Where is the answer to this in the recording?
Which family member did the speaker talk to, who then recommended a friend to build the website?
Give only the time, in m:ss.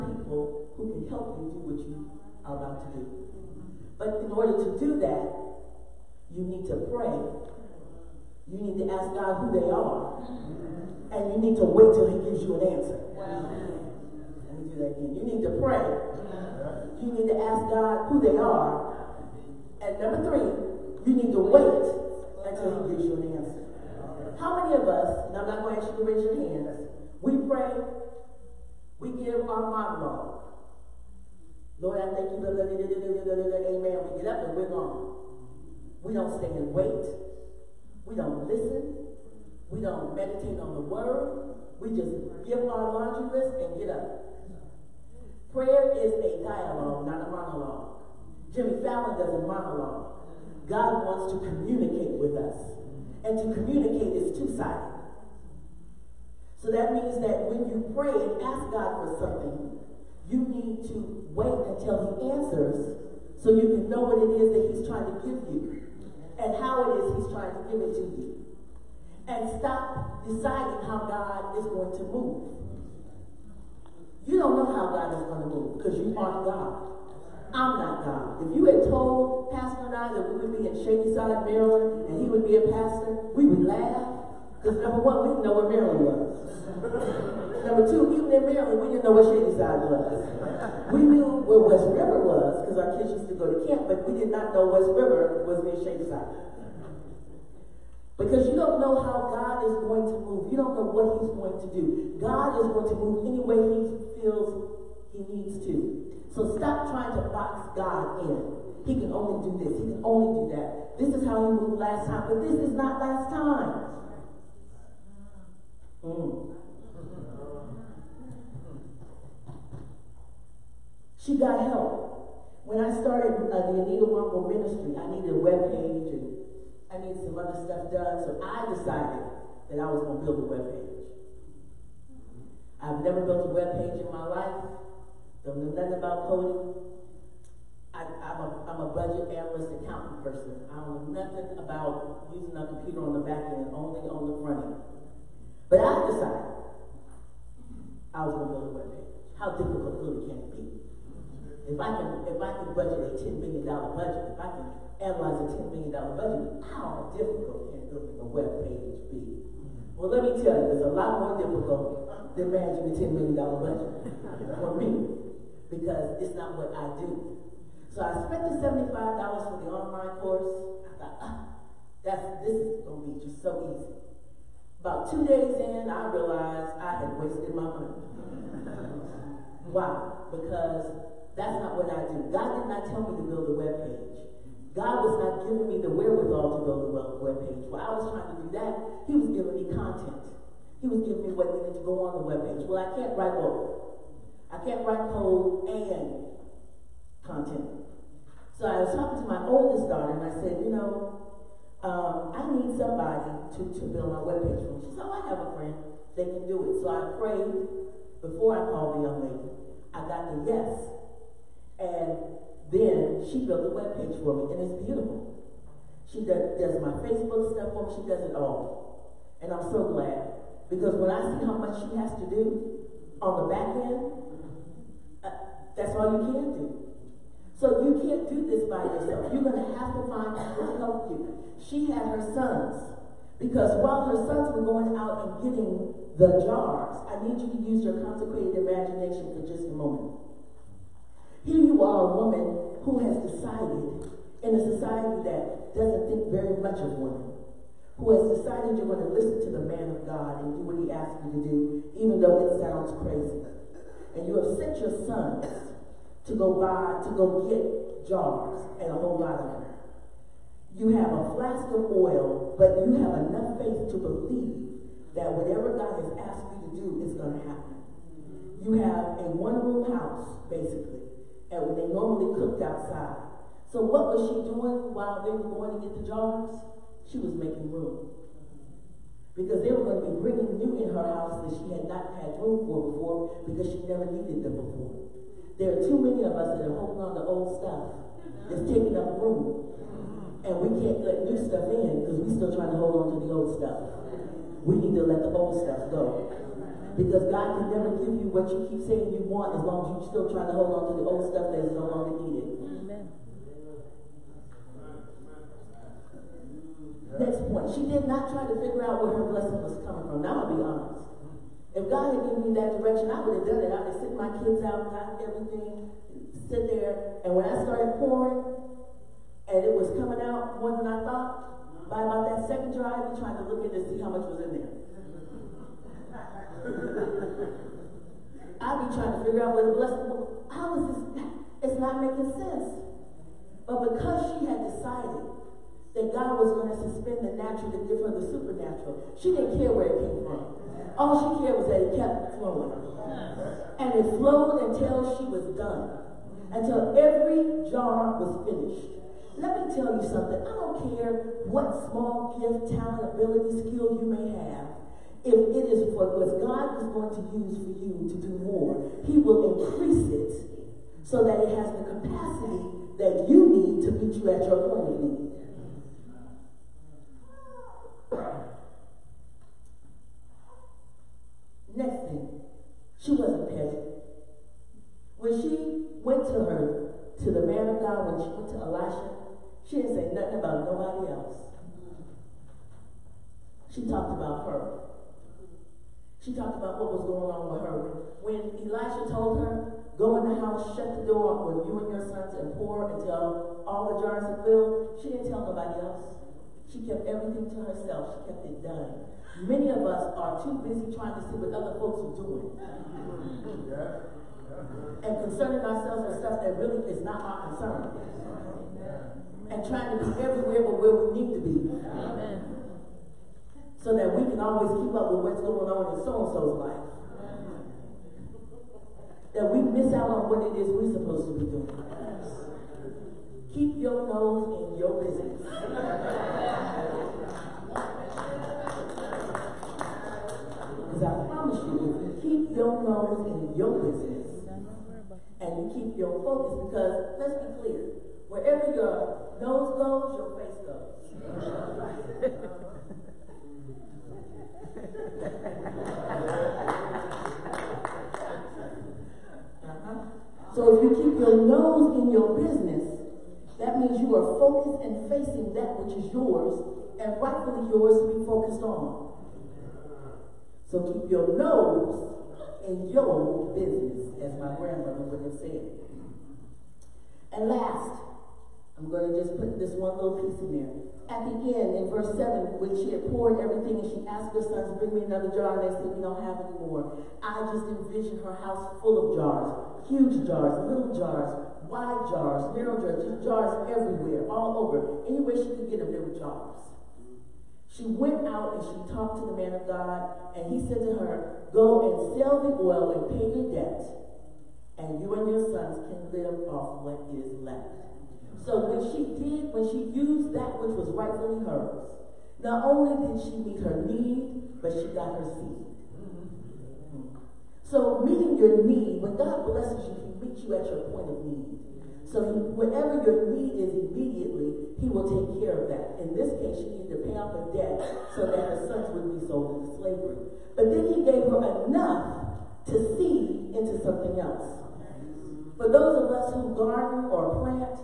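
3:19.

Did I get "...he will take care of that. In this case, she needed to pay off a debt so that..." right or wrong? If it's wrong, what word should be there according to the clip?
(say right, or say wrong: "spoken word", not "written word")
right.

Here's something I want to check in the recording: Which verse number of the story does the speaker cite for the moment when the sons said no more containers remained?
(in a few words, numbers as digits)
7.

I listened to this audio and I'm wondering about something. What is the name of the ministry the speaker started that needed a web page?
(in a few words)
Anita Wamble ministry.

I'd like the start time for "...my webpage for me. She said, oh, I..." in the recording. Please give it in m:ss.
3:24.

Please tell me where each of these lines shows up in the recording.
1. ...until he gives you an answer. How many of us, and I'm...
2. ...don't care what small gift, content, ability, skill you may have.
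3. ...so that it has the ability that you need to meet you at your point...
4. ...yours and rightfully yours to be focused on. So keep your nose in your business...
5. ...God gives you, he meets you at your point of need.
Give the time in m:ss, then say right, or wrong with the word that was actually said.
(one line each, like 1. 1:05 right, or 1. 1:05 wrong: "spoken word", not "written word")
1. 0:22 right
2. 5:50 wrong: "talent", not "content"
3. 6:01 wrong: "capacity", not "ability"
4. 7:36 right
5. 8:29 wrong: "blesses", not "gives".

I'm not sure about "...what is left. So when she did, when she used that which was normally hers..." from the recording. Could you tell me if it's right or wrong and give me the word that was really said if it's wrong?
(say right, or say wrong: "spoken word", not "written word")
wrong: "rightfully", not "normally".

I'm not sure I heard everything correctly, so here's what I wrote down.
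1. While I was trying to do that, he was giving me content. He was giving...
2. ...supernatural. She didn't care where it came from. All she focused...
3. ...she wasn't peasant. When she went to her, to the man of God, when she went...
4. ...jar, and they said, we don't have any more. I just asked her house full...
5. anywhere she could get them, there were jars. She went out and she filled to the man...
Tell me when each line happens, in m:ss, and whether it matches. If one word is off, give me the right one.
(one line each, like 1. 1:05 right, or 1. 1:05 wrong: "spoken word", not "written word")
1. 3:07 right
2. 5:38 wrong: "cared", not "focused"
3. 6:12 right
4. 7:55 wrong: "envisioned", not "asked"
5. 8:05 wrong: "talked", not "filled".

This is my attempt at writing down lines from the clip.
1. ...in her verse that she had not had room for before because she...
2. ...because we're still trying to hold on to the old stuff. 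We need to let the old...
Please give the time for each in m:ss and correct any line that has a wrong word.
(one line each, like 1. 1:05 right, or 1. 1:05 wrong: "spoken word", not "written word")
1. 4:40 wrong: "house", not "verse"
2. 4:52 right.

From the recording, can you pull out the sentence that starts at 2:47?
So I spent the $75 for the online course.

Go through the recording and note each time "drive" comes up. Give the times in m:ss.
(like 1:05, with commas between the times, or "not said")
5:22.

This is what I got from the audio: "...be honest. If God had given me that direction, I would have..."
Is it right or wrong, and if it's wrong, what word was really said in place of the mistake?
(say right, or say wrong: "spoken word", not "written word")
right.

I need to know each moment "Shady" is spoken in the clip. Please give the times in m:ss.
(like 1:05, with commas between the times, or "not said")
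1:20, 1:29, 1:35.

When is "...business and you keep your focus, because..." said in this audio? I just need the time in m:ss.
7:13.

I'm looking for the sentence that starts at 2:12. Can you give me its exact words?
I've never built a web page in my life.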